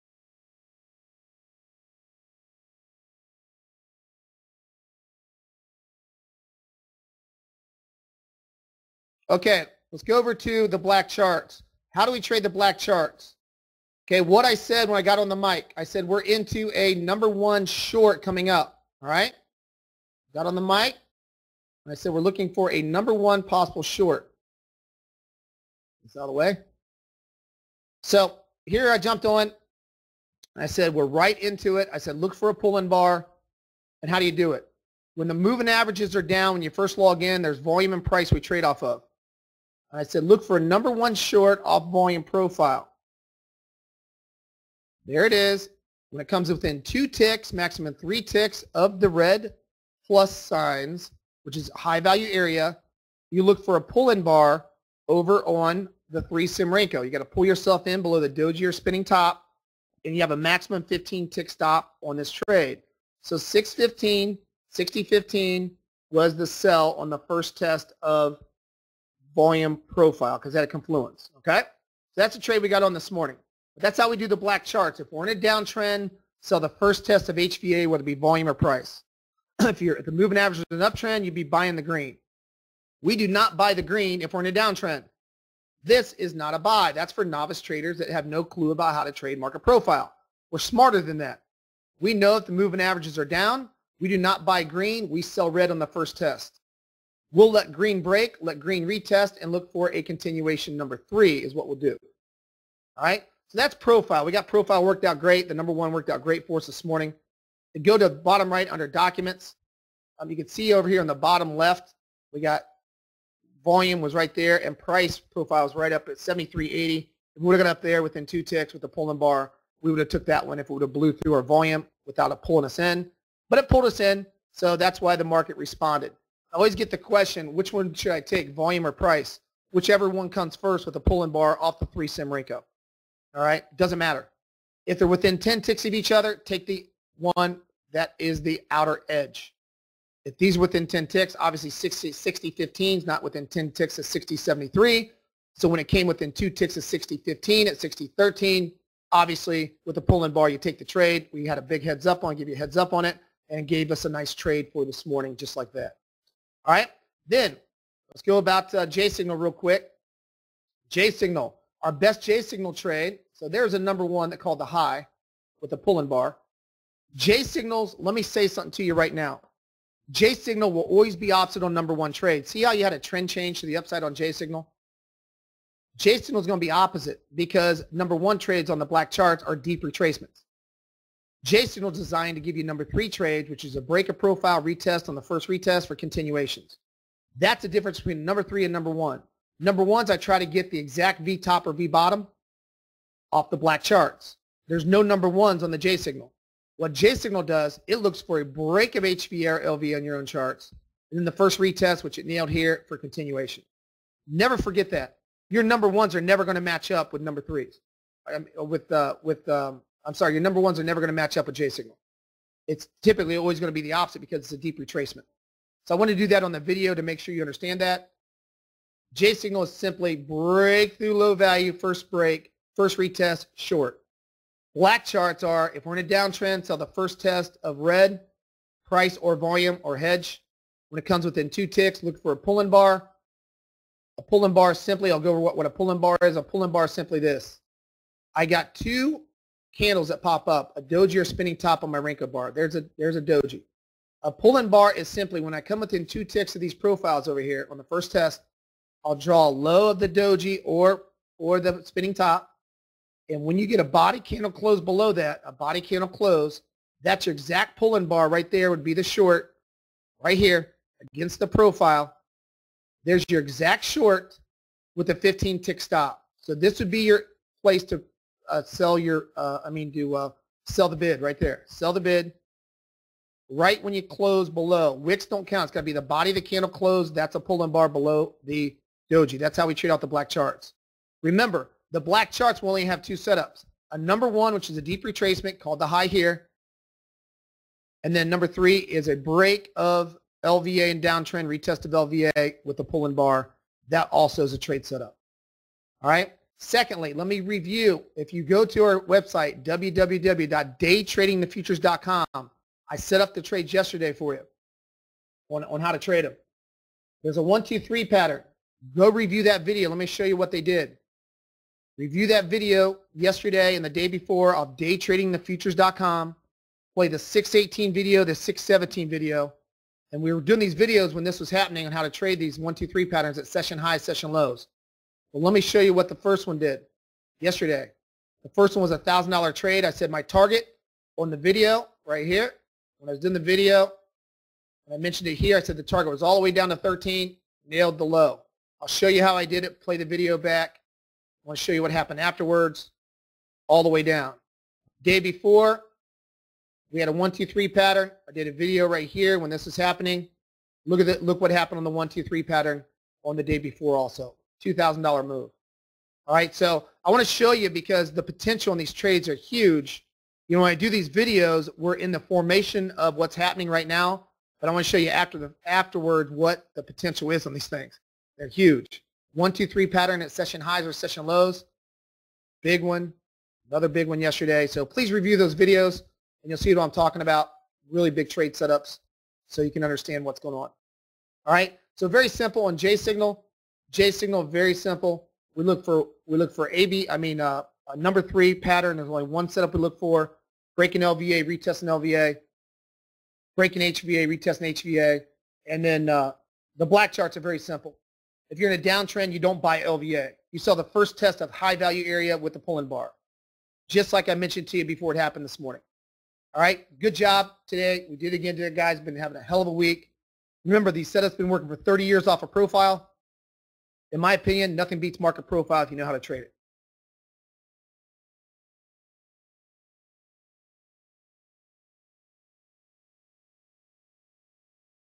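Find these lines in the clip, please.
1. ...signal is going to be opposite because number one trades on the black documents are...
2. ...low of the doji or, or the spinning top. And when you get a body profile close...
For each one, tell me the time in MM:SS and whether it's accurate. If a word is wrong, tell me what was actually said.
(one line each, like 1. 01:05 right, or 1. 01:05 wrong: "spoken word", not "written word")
1. 02:56 wrong: "charts", not "documents"
2. 04:09 wrong: "candle", not "profile".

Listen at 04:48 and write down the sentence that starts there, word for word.
And then number three is a break of LVA and downtrend, retest of LVA with a pull-in bar.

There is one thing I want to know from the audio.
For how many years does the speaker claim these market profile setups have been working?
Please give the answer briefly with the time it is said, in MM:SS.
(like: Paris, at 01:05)
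30 years, at 06:51.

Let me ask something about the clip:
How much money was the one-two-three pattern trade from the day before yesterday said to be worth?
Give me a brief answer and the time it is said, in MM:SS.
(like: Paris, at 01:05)
$2,000, at 05:54.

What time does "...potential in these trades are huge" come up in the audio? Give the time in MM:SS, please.
05:58.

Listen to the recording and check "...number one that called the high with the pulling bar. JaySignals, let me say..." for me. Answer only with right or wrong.
right.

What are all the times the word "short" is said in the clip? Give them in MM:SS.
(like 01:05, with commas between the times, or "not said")
00:17, 00:23, 00:41, 03:43, 04:19, 04:23.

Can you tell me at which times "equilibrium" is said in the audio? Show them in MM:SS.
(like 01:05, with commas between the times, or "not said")
not said.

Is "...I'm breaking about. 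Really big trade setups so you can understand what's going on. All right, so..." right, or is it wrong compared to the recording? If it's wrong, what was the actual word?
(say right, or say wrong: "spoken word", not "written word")
wrong: "talking", not "breaking".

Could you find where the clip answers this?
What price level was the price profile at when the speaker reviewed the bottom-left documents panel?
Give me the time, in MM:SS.
01:56.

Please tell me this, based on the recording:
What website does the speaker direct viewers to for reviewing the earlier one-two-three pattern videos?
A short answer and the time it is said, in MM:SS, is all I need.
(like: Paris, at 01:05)
daytradingthefutures.com, at 04:59.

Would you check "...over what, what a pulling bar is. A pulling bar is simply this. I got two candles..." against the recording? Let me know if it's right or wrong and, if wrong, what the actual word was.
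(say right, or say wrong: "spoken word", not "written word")
right.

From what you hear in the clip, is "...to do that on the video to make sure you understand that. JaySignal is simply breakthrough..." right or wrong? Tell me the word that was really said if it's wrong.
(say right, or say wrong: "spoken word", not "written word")
right.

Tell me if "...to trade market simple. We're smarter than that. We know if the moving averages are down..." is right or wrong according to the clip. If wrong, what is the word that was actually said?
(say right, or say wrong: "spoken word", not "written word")
wrong: "profile", not "simple".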